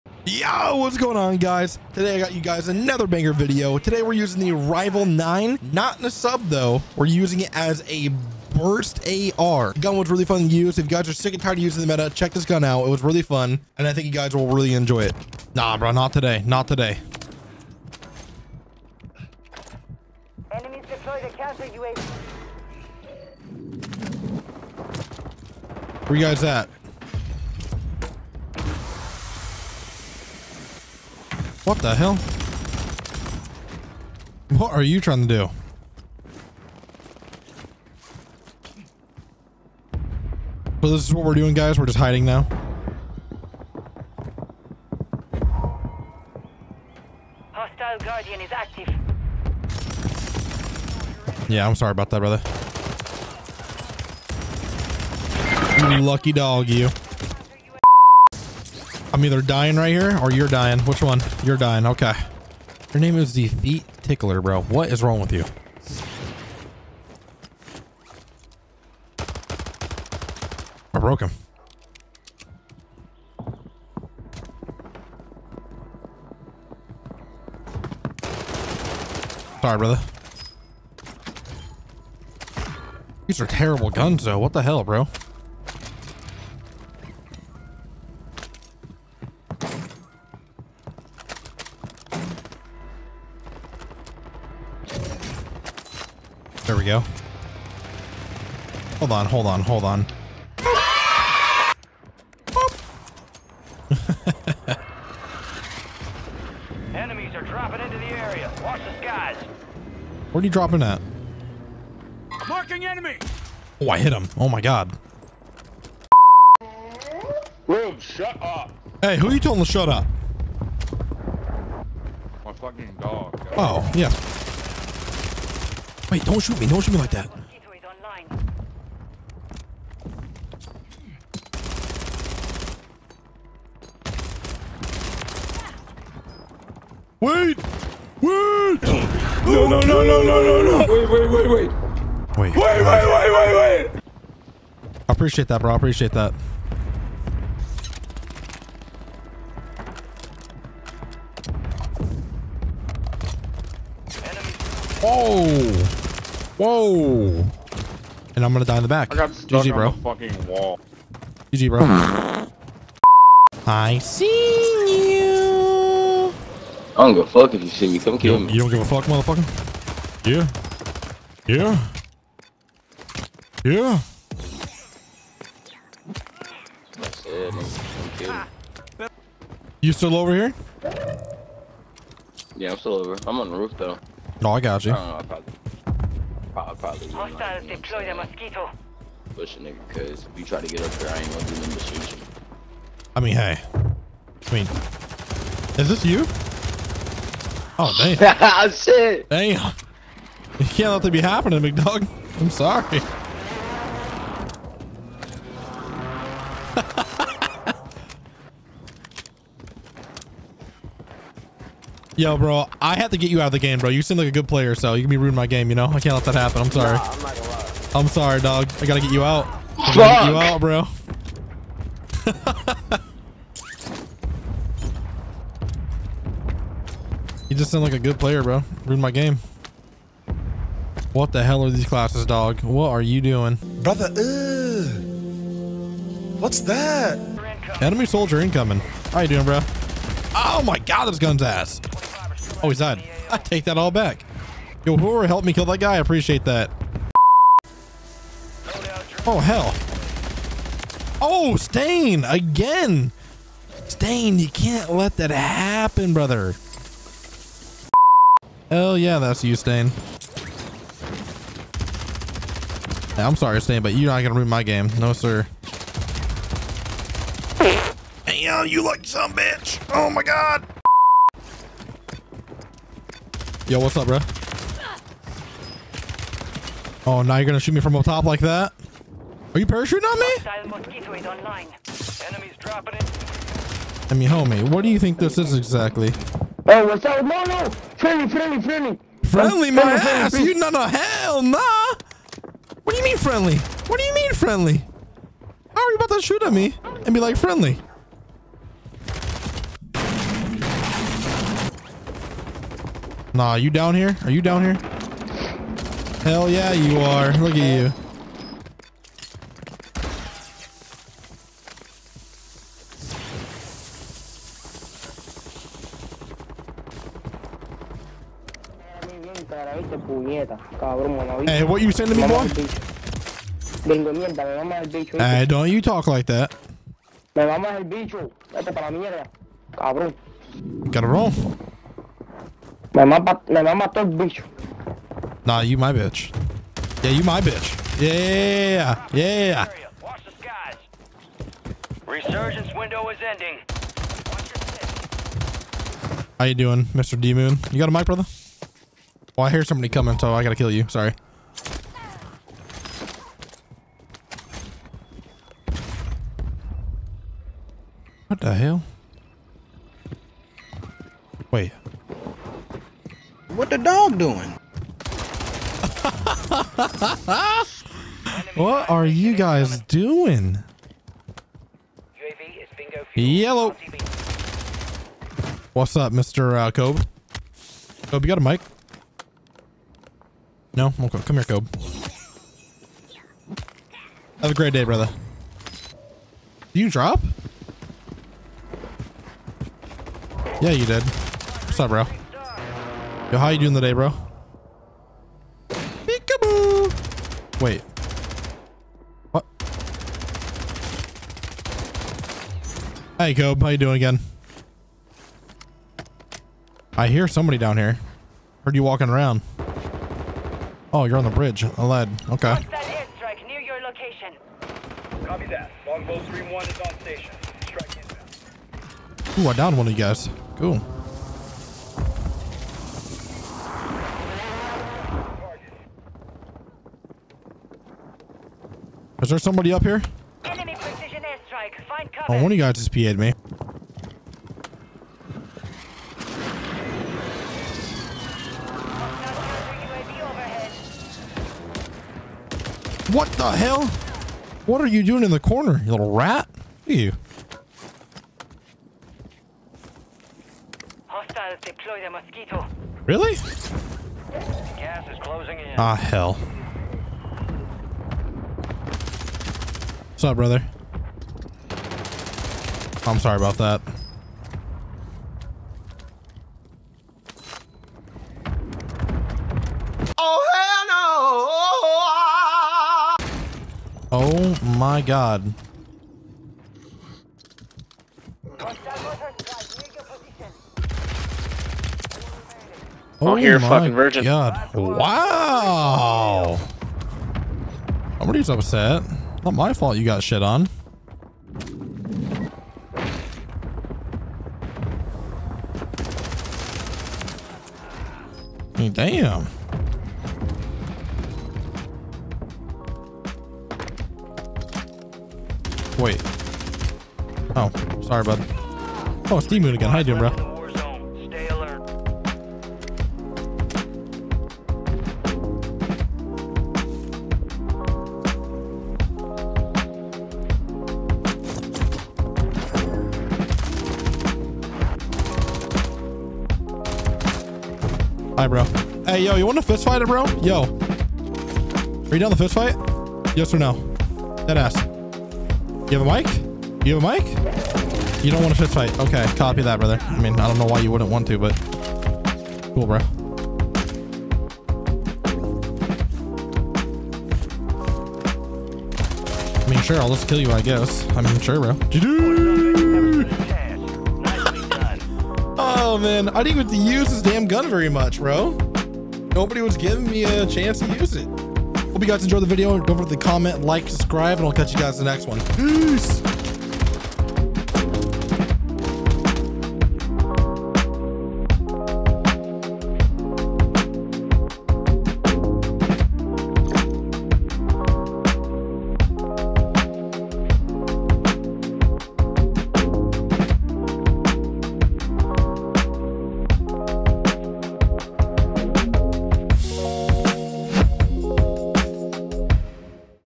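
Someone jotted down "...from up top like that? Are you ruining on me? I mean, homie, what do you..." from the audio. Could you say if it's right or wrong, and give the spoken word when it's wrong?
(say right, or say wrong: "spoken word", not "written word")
wrong: "parachuting", not "ruining".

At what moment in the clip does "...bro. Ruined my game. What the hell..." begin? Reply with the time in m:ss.
3:48.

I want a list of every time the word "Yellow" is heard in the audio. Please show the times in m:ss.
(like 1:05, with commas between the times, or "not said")
6:13.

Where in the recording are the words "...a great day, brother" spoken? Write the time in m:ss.
6:24.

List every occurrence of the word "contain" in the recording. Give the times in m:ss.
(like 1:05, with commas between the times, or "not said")
not said.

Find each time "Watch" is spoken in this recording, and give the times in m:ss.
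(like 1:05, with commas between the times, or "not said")
1:48, 5:40.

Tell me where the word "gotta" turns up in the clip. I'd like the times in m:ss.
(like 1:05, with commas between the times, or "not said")
3:38, 5:50.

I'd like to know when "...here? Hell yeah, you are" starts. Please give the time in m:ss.
5:04.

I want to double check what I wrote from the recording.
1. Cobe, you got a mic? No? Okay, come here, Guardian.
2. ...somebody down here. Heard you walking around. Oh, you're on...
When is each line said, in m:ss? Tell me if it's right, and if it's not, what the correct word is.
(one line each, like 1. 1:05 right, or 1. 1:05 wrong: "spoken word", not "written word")
1. 6:18 wrong: "Cobe", not "Guardian"
2. 6:47 right.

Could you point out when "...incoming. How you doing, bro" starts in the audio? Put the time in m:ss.
3:58.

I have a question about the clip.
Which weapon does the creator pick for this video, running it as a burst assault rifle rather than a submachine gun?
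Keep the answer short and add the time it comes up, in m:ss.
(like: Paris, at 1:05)
Rival 9, at 0:04.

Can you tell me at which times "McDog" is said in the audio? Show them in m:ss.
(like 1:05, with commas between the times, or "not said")
3:21.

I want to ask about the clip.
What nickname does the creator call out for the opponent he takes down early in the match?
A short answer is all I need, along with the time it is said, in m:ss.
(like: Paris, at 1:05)
the Feet Tickler, at 1:03.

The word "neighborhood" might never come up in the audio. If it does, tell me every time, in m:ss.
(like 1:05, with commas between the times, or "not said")
not said.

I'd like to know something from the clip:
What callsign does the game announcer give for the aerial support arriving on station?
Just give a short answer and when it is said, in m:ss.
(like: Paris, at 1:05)
Longbow one, at 6:55.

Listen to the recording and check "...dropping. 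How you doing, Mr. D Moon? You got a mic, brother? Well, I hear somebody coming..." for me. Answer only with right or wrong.
wrong.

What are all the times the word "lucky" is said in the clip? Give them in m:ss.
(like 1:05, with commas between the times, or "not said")
0:56, 4:28.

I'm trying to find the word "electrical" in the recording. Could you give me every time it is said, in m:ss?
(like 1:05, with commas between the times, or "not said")
not said.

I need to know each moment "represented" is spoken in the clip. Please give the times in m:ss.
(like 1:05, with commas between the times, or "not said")
not said.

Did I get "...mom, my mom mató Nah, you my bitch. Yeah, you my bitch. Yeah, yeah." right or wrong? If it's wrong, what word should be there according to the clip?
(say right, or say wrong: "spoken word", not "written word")
right.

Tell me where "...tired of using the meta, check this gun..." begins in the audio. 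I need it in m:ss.
0:11.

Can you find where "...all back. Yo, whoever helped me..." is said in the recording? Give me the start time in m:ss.
4:03.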